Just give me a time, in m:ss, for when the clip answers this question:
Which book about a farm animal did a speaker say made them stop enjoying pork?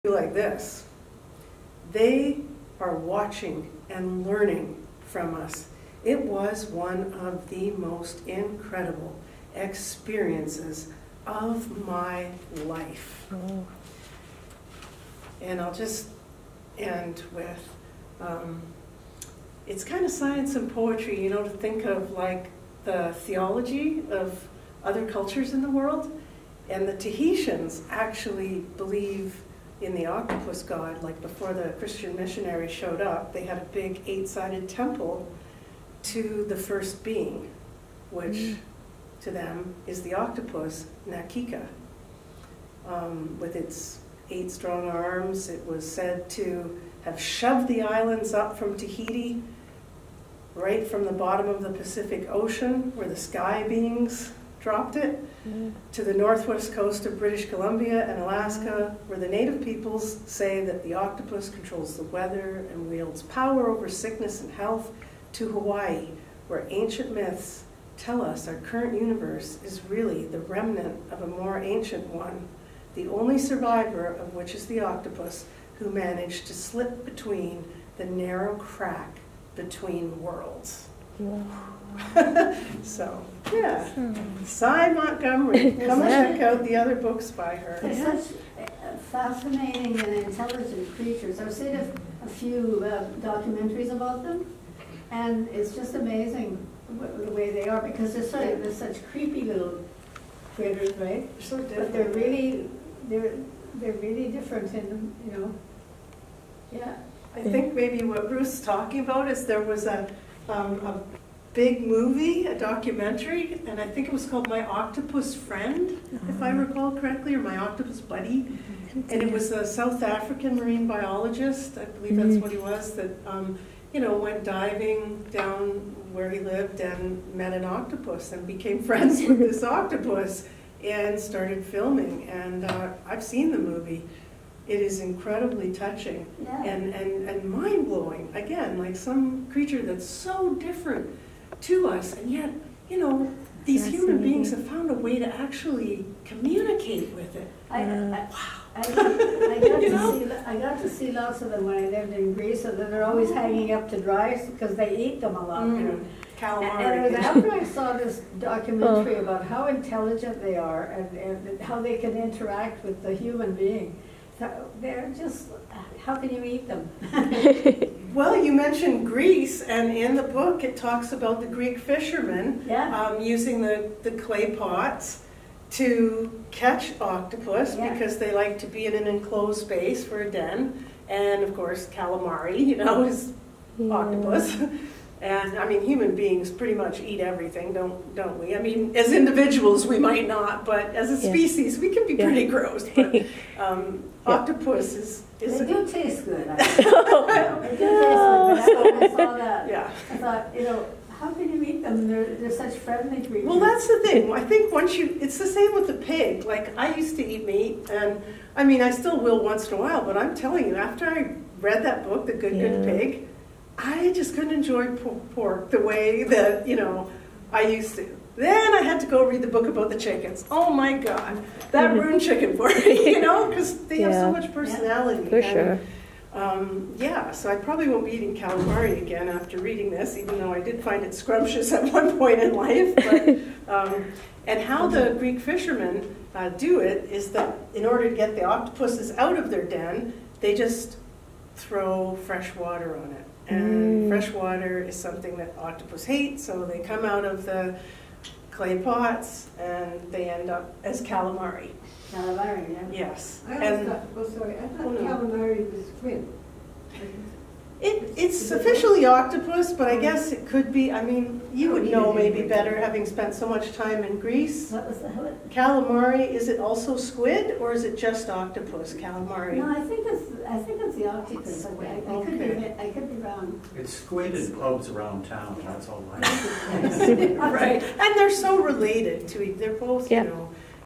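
3:32.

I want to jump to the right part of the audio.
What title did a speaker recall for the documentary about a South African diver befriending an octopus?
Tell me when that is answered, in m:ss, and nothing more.
1:54.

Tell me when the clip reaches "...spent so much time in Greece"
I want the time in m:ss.
4:23.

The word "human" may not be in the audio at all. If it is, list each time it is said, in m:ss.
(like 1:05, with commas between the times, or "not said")
2:23, 2:43, 3:05.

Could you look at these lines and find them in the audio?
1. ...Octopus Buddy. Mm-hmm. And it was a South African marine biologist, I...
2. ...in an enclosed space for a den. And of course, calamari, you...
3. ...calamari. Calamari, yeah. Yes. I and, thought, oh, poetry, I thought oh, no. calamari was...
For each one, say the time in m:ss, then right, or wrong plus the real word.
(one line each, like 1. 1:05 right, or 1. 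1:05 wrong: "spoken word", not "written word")
1. 1:57 right
2. 2:58 right
3. 4:11 wrong: "sorry", not "poetry".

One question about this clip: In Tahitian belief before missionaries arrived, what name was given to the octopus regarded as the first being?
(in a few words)
Nakika.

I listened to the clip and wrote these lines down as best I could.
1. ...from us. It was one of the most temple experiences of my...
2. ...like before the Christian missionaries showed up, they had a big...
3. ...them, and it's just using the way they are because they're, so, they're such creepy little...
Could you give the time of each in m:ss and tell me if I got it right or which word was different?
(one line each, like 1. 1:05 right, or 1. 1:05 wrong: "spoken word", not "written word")
1. 0:05 wrong: "incredible", not "temple"
2. 0:31 right
3. 1:34 wrong: "amazing", not "using".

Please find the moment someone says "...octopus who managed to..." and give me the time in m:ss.
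1:14.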